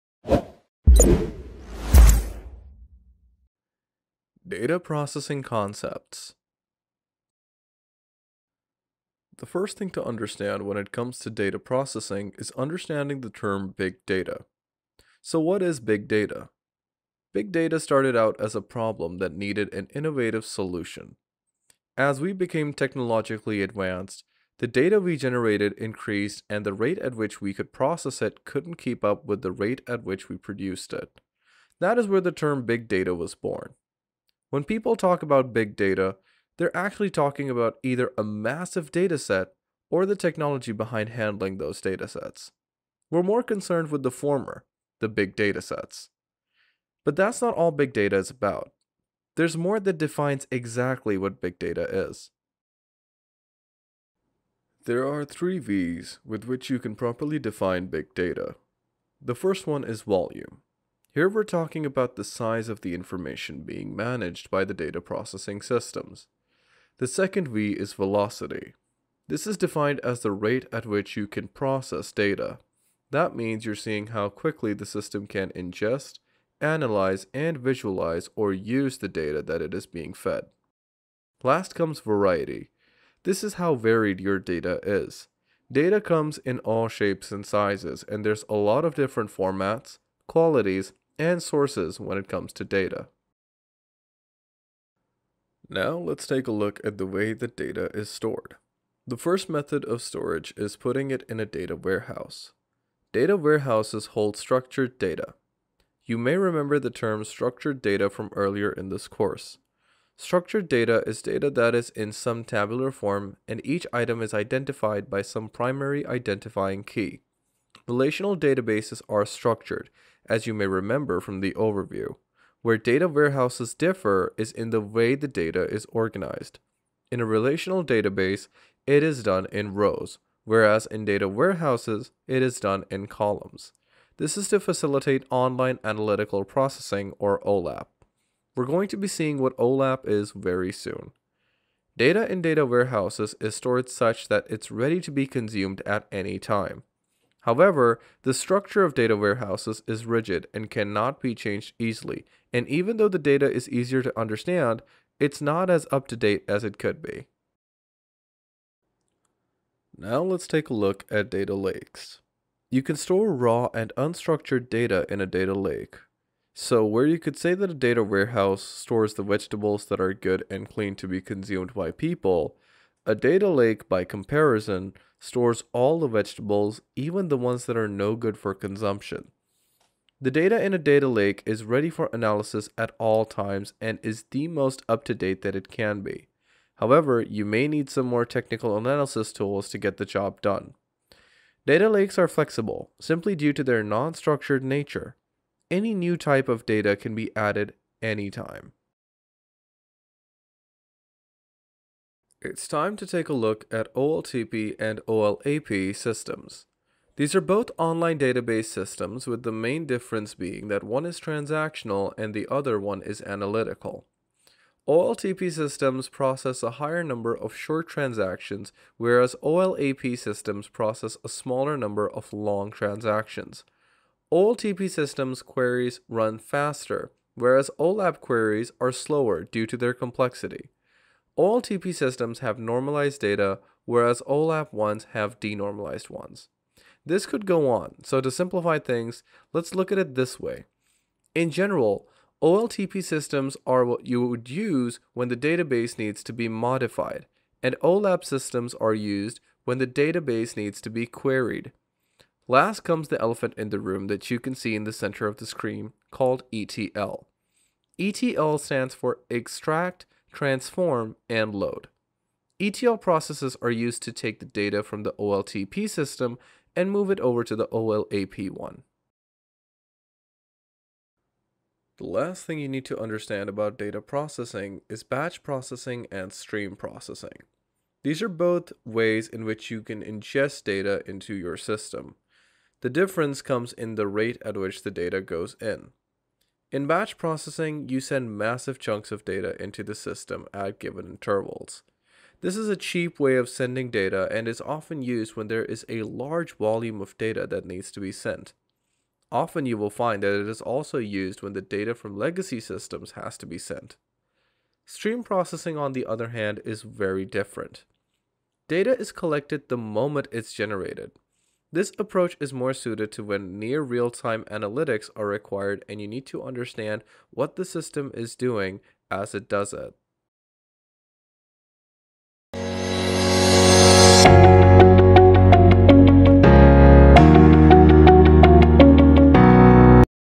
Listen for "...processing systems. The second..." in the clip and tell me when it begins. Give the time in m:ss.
1:05.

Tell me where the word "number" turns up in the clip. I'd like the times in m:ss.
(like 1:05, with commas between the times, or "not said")
3:37, 3:41.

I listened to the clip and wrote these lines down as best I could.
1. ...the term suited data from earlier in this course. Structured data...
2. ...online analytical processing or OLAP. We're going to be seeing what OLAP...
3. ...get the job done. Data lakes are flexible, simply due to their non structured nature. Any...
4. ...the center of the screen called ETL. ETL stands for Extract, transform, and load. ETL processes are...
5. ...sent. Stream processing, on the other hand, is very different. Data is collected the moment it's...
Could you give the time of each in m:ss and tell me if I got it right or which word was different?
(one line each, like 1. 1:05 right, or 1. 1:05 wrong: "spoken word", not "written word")
1. 1:46 wrong: "structured", not "suited"
2. 2:15 right
3. 3:09 right
4. 4:14 right
5. 5:03 right.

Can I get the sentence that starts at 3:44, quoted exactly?
OLTP systems queries run faster, whereas OLAP queries are slower due to their complexity.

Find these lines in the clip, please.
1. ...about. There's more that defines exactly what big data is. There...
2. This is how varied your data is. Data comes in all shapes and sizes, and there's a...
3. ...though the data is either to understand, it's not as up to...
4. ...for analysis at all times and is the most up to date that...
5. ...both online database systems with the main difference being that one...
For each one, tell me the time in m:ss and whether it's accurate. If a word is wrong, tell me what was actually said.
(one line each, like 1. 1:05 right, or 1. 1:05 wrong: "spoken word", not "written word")
1. 0:48 right
2. 1:23 right
3. 2:32 wrong: "easier", not "either"
4. 3:01 right
5. 3:27 right.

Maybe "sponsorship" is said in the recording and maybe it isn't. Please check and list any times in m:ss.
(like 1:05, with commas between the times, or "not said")
not said.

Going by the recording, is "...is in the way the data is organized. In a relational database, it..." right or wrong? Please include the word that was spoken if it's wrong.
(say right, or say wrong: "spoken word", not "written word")
right.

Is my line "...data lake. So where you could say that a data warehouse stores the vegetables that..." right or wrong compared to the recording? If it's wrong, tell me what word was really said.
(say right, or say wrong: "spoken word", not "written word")
right.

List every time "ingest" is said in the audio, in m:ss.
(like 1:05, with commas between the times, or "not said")
1:15, 4:40.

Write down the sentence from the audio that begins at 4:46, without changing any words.
In batch processing, you send massive chunks of data into the system at given intervals.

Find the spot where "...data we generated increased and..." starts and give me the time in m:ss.
0:24.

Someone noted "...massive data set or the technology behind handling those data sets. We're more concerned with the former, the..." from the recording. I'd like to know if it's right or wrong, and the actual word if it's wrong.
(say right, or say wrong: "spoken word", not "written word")
right.